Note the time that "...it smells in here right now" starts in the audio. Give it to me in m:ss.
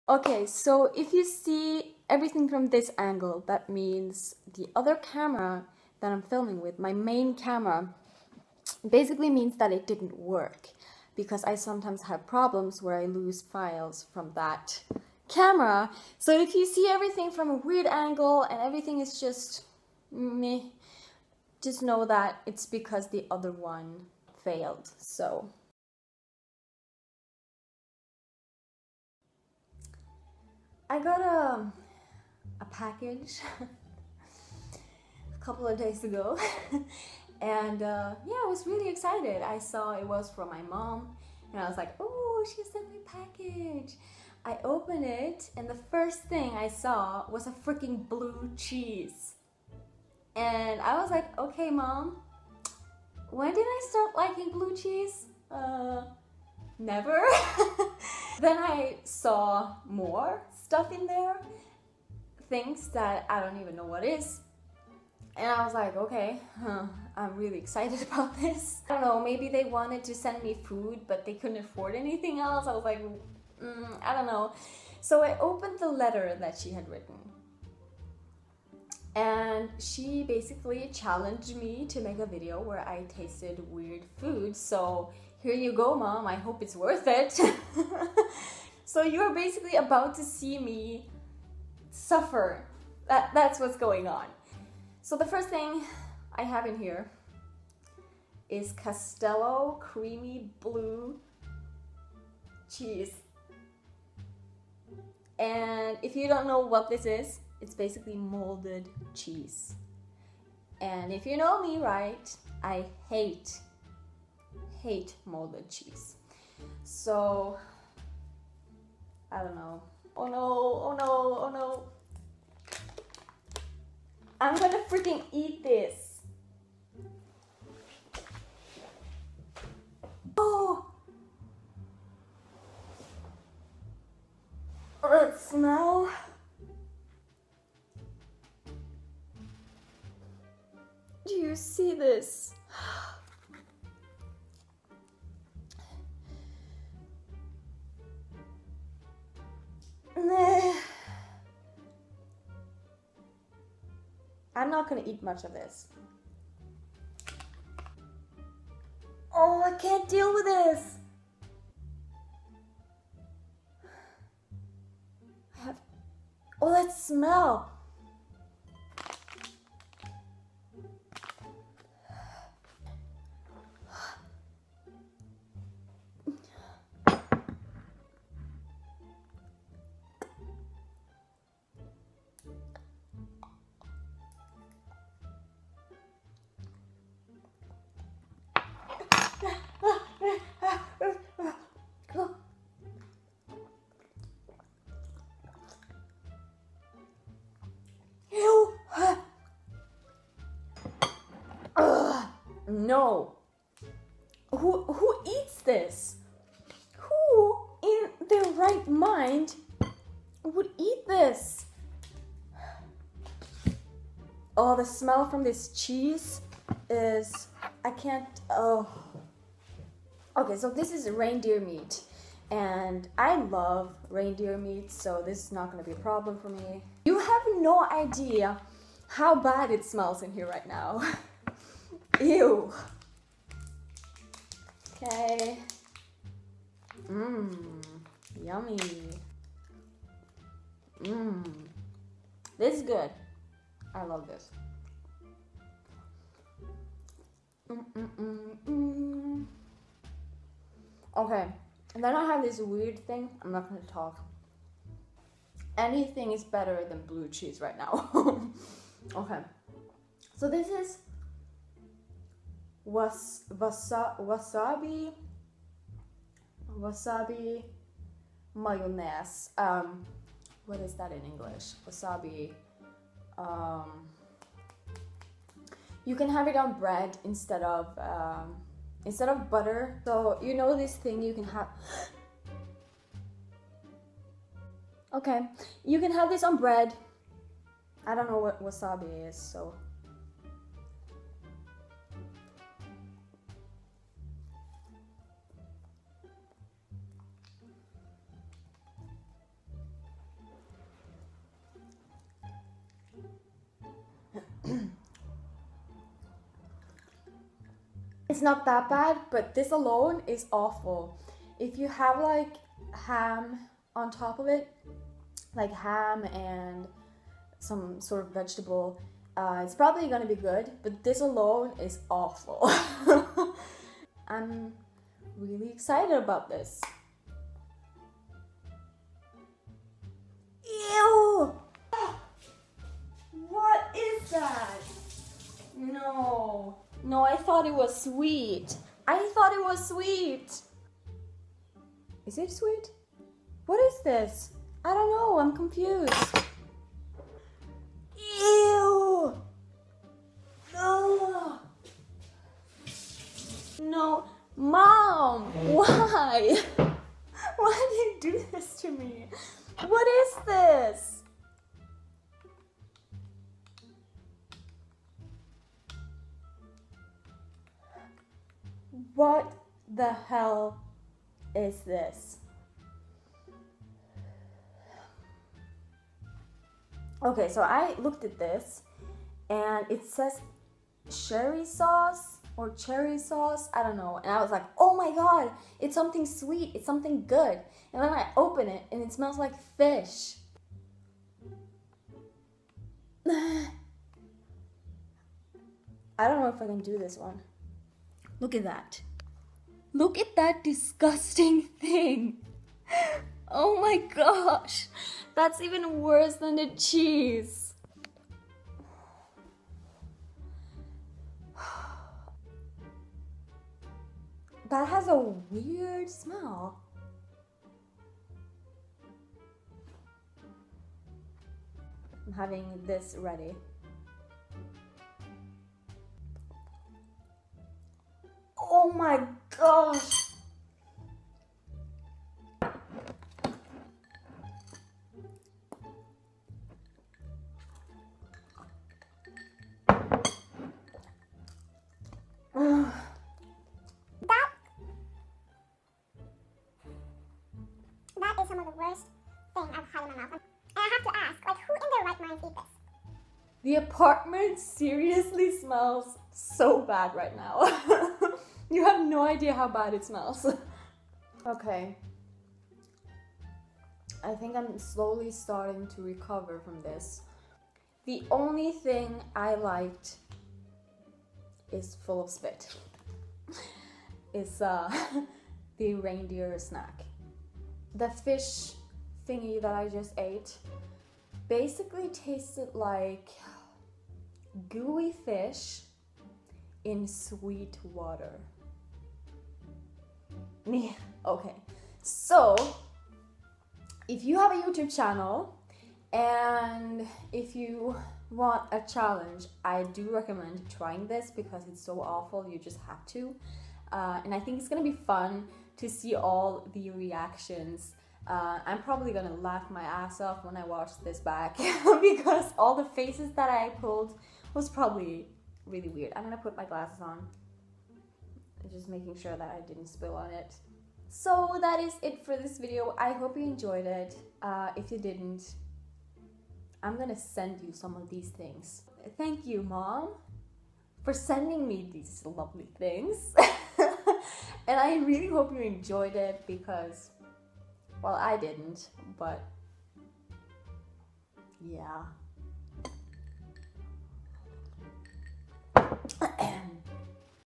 3:49.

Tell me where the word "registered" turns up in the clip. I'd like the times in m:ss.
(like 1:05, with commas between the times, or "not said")
not said.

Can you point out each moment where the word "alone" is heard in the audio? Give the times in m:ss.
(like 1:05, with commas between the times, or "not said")
5:09, 5:21.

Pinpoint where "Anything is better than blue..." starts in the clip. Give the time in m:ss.
4:15.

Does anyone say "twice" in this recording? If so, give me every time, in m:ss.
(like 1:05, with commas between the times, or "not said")
not said.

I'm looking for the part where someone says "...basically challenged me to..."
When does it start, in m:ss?
1:20.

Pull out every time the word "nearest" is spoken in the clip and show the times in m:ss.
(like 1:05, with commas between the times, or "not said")
not said.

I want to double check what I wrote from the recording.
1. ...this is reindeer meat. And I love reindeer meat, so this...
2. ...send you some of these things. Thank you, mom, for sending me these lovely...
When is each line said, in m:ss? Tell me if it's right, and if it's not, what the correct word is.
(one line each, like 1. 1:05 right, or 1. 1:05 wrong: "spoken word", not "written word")
1. 3:40 right
2. 8:47 right.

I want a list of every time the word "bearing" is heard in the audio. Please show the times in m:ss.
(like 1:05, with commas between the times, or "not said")
not said.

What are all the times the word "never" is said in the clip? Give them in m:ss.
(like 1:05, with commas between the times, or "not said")
0:56.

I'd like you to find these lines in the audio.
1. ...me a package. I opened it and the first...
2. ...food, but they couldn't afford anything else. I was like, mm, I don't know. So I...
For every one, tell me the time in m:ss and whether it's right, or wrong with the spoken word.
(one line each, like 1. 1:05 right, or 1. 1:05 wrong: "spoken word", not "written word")
1. 0:42 right
2. 1:10 right.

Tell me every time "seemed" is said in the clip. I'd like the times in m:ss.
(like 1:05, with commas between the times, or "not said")
not said.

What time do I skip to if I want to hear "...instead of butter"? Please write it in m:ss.
4:39.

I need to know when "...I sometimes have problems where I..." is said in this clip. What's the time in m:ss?
0:11.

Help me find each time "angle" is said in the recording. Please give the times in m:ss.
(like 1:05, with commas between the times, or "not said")
0:02, 0:17.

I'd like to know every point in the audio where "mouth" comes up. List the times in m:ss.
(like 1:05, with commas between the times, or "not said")
7:30.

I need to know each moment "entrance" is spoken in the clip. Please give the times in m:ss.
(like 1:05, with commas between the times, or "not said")
not said.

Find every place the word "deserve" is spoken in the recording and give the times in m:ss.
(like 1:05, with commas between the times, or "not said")
not said.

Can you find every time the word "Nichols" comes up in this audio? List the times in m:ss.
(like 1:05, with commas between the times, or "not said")
not said.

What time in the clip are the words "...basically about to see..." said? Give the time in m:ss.
1:29.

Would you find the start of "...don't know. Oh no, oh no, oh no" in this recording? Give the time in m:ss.
1:59.